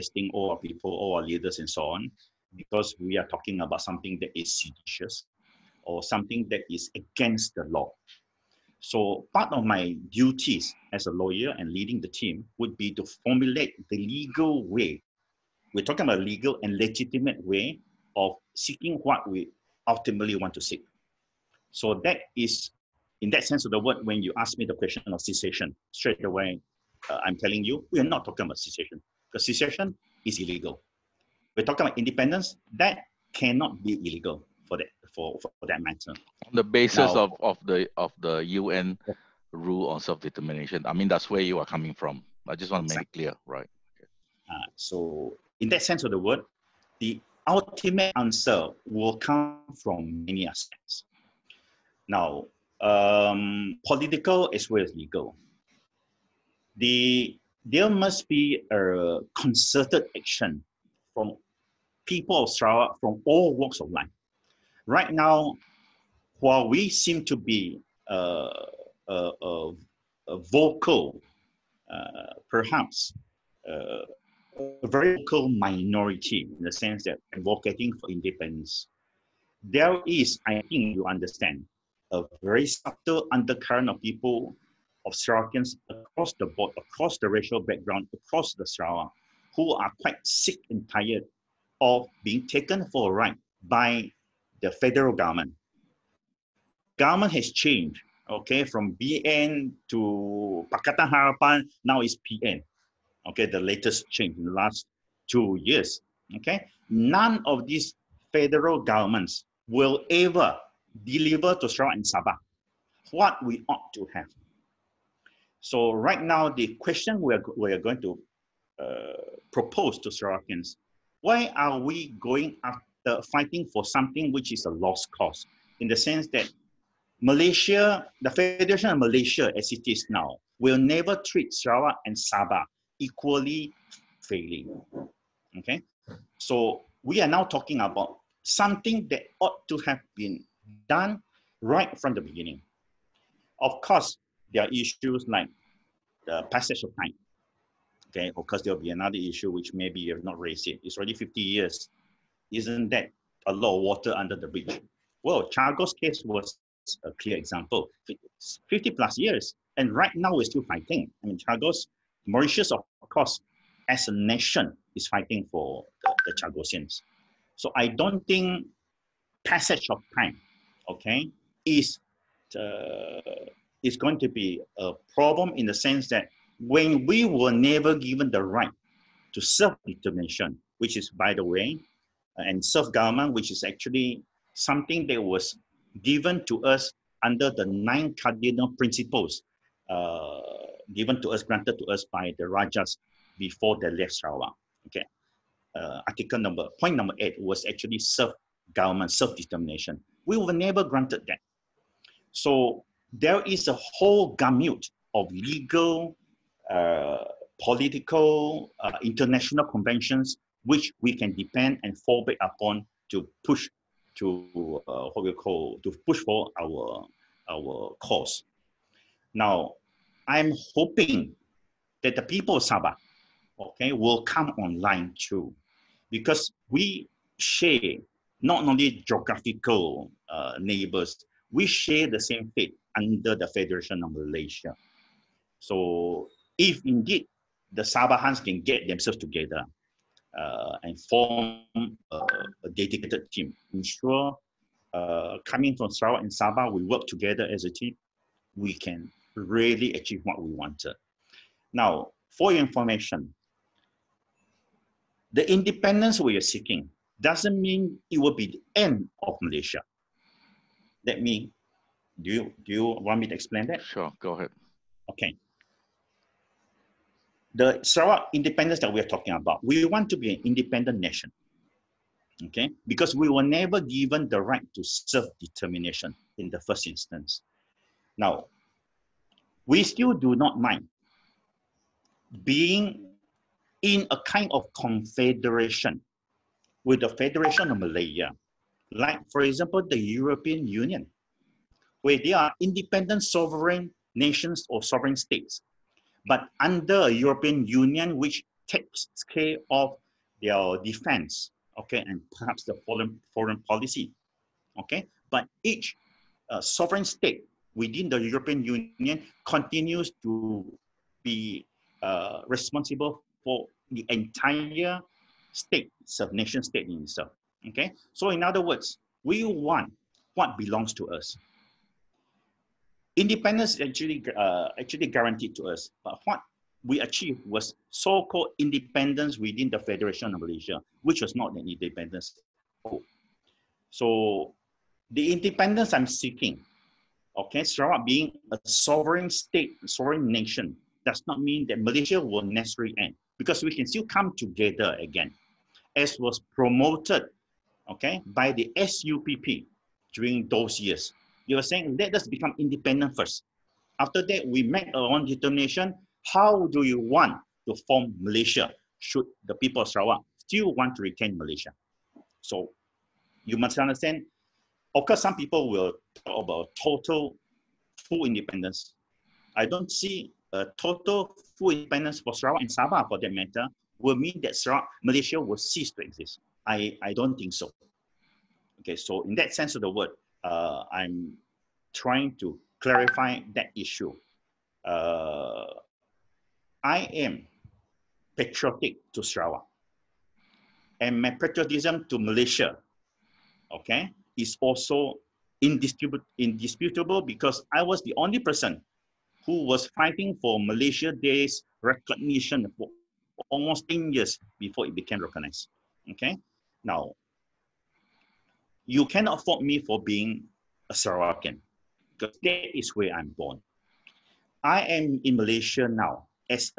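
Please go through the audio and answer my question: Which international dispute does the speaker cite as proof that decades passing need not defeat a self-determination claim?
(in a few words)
Chagos case.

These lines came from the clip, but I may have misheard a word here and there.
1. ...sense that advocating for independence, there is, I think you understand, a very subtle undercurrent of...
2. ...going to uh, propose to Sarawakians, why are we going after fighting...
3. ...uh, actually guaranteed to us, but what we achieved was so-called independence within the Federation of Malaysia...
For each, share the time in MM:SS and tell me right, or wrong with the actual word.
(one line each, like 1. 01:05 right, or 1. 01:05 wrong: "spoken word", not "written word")
1. 01:16 right
2. 01:57 right
3. 05:24 right.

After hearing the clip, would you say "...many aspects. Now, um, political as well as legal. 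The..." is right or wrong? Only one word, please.
right.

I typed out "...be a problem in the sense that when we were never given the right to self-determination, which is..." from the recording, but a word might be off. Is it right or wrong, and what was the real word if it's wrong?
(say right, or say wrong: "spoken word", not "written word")
right.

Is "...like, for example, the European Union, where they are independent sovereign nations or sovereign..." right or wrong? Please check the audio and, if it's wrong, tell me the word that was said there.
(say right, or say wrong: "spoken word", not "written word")
right.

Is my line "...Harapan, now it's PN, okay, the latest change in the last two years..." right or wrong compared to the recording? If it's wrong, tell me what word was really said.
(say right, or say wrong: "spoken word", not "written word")
right.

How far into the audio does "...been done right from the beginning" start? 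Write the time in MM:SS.
02:20.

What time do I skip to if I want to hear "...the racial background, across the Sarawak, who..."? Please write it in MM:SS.
01:27.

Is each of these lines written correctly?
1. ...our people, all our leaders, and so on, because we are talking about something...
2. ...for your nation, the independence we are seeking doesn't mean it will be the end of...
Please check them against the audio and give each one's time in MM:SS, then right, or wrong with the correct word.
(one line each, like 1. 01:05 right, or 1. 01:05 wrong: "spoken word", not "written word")
1. 00:00 right
2. 04:12 wrong: "information", not "nation".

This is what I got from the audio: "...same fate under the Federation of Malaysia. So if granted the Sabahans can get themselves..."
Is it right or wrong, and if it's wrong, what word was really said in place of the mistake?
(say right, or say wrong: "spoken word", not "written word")
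wrong: "indeed", not "granted".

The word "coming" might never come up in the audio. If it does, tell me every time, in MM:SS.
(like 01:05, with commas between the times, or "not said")
00:41, 04:05.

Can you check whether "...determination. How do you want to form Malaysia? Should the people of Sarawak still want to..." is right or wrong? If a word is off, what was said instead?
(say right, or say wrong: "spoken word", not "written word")
right.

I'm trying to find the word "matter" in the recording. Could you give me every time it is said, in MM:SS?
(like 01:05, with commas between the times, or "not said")
00:35, 06:13.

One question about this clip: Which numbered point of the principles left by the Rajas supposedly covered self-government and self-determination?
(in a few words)
8.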